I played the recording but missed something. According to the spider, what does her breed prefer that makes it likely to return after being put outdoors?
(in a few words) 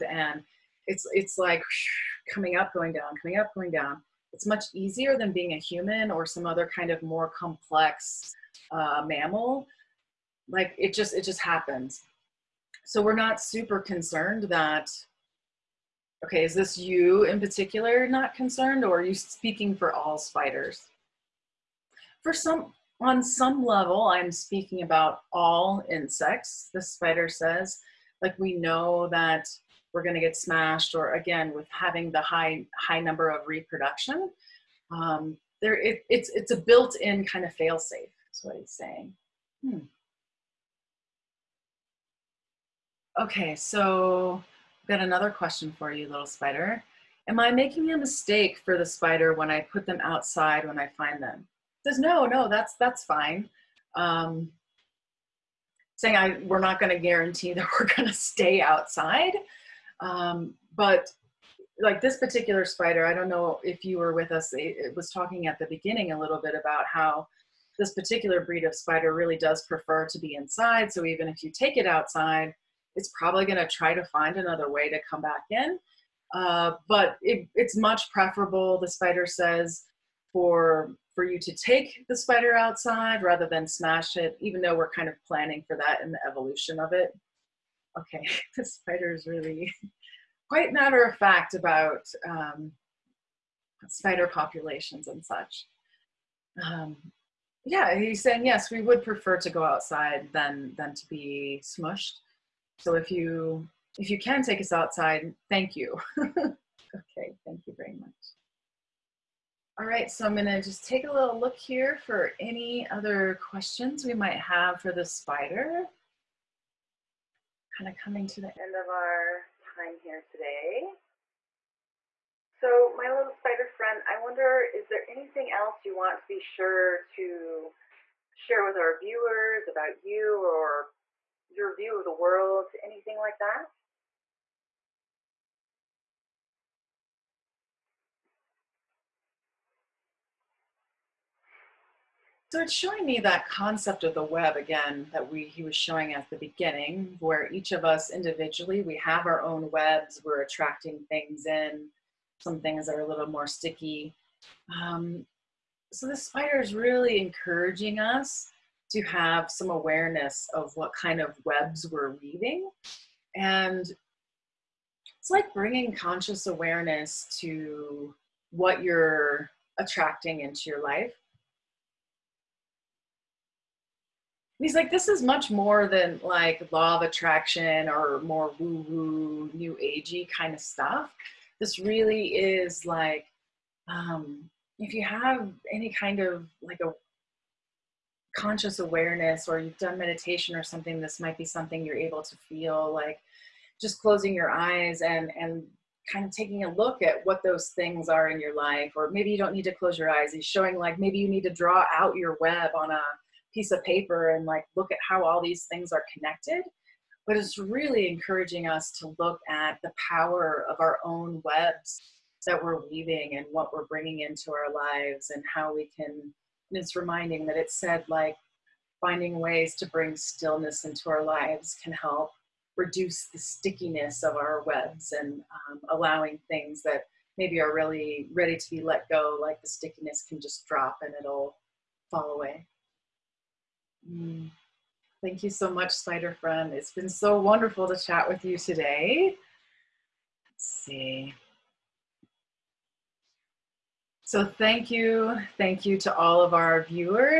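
to be inside.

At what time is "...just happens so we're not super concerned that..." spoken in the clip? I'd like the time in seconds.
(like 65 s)
11 s.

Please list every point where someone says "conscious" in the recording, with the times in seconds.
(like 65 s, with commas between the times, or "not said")
165 s, 188 s.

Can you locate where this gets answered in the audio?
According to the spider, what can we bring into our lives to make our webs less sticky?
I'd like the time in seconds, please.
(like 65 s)
220 s.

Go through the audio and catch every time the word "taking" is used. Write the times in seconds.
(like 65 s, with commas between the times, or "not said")
196 s.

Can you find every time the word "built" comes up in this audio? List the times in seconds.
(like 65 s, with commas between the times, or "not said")
36 s.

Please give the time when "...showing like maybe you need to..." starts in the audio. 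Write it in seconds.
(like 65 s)
200 s.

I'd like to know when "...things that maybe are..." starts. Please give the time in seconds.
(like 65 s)
226 s.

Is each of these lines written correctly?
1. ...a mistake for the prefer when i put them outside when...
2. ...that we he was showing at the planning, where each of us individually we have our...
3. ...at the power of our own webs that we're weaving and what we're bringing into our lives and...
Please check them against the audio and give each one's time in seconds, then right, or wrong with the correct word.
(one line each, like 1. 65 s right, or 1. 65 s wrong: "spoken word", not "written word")
1. 47 s wrong: "spider", not "prefer"
2. 145 s wrong: "beginning", not "planning"
3. 209 s right.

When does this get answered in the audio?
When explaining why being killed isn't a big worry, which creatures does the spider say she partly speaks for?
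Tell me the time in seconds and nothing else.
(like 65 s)
25 s.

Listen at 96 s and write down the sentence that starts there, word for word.
Um, yeah, he's saying yes, we would prefer to go outside than than to be smushed.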